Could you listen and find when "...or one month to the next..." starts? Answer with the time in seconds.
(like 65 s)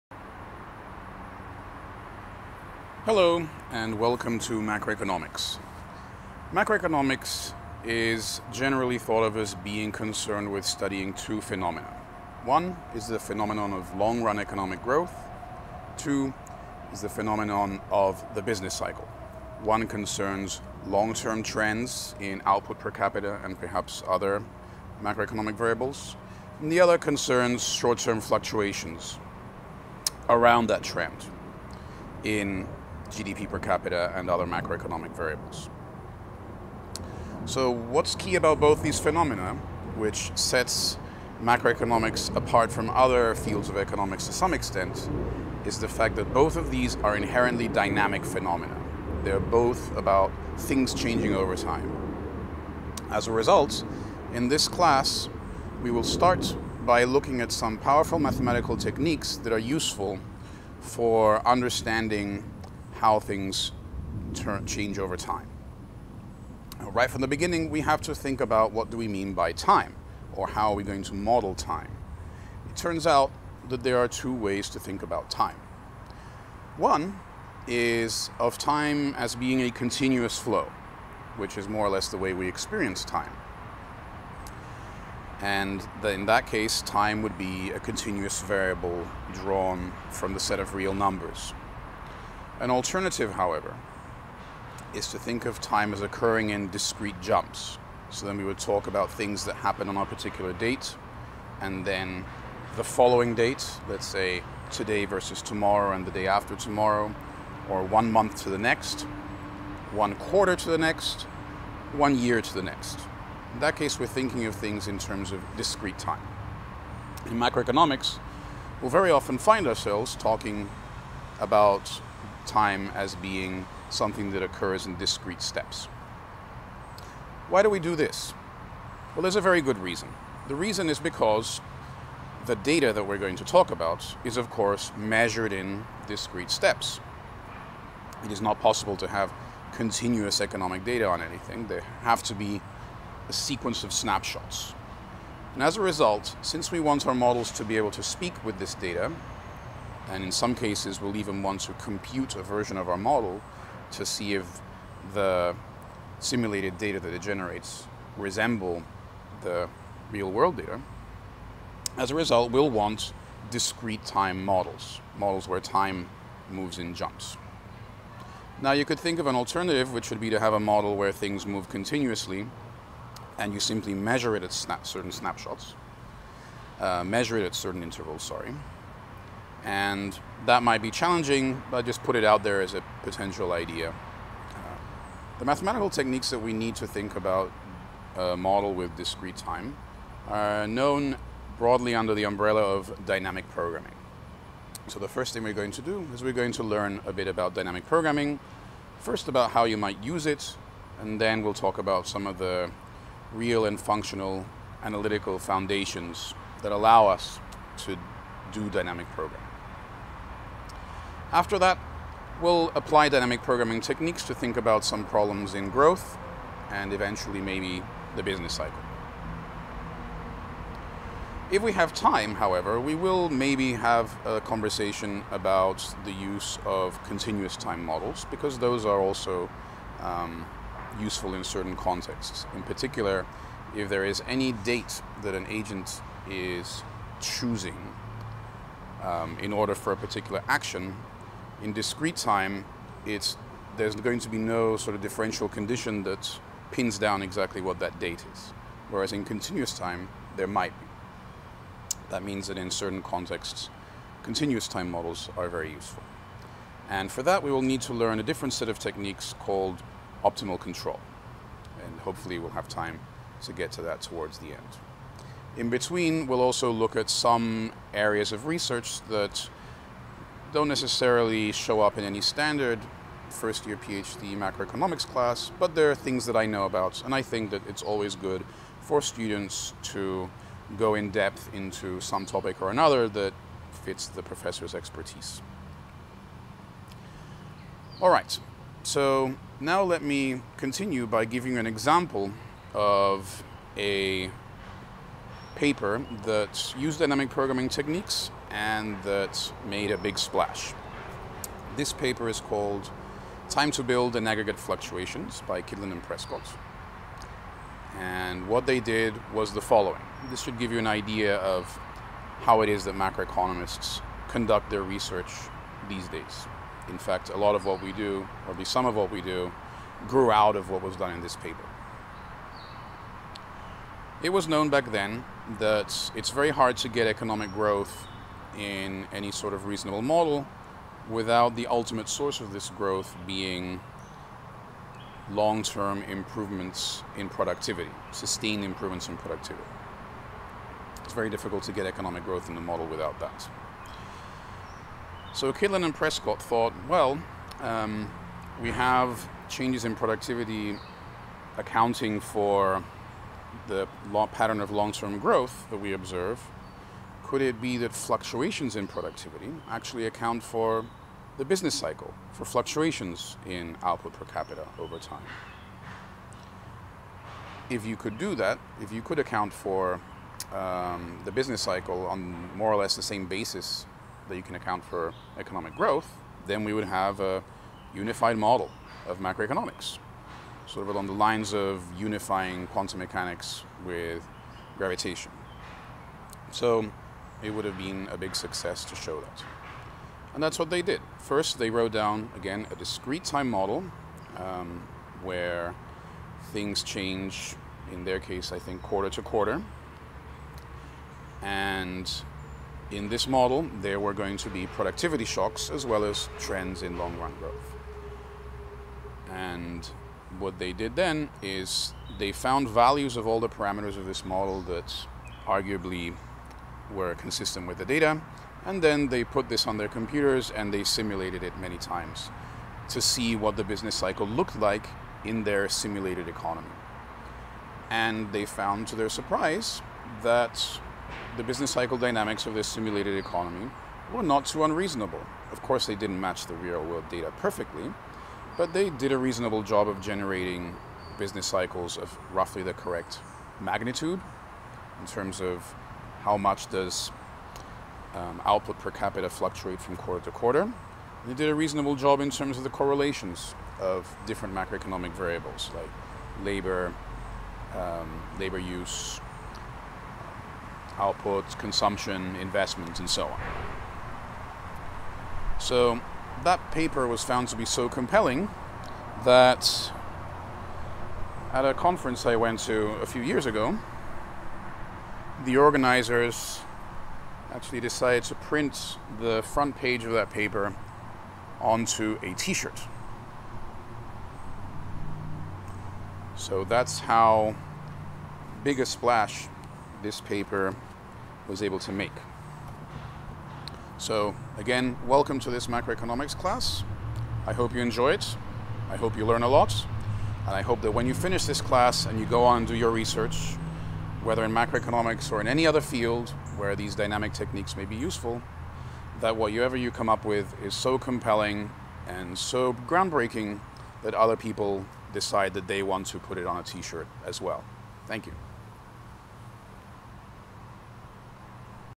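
107 s.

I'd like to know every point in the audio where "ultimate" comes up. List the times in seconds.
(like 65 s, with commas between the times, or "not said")
331 s.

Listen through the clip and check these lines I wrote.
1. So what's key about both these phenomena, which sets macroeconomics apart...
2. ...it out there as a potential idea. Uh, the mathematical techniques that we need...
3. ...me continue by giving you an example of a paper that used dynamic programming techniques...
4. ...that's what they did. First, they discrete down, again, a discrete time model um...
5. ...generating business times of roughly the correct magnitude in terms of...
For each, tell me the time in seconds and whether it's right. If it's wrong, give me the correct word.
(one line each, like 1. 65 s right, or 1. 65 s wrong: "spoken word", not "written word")
1. 37 s right
2. 182 s right
3. 290 s right
4. 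390 s wrong: "wrote", not "discrete"
5. 440 s wrong: "cycles", not "times".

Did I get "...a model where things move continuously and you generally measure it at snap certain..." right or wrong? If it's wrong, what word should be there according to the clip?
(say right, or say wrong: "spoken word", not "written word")
wrong: "simply", not "generally".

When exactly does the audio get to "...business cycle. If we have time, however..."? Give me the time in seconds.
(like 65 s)
218 s.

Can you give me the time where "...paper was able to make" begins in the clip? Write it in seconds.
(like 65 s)
490 s.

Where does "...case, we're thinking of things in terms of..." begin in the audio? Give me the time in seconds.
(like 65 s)
113 s.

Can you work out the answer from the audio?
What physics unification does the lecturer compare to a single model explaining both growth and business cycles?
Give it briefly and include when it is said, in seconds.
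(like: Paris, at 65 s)
Quantum mechanics with gravitation, at 382 s.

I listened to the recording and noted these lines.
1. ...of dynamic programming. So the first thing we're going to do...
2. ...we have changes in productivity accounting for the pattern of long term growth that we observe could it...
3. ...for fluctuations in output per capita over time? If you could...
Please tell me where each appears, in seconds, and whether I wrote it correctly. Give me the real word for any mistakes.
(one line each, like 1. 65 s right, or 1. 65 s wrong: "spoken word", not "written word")
1. 192 s right
2. 348 s right
3. 362 s right.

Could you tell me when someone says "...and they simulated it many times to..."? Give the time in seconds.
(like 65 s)
420 s.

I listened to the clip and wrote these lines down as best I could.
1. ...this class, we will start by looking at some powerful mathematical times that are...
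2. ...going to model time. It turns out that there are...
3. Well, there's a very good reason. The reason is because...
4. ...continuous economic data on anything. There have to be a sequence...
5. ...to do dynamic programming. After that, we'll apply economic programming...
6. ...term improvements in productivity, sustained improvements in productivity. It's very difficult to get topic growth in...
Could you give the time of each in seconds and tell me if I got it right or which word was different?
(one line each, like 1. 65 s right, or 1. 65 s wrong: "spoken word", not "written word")
1. 54 s wrong: "techniques", not "times"
2. 70 s right
3. 129 s right
4. 139 s right
5. 207 s wrong: "dynamic", not "economic"
6. 335 s wrong: "economic", not "topic".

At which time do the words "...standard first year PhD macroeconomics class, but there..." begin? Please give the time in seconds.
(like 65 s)
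272 s.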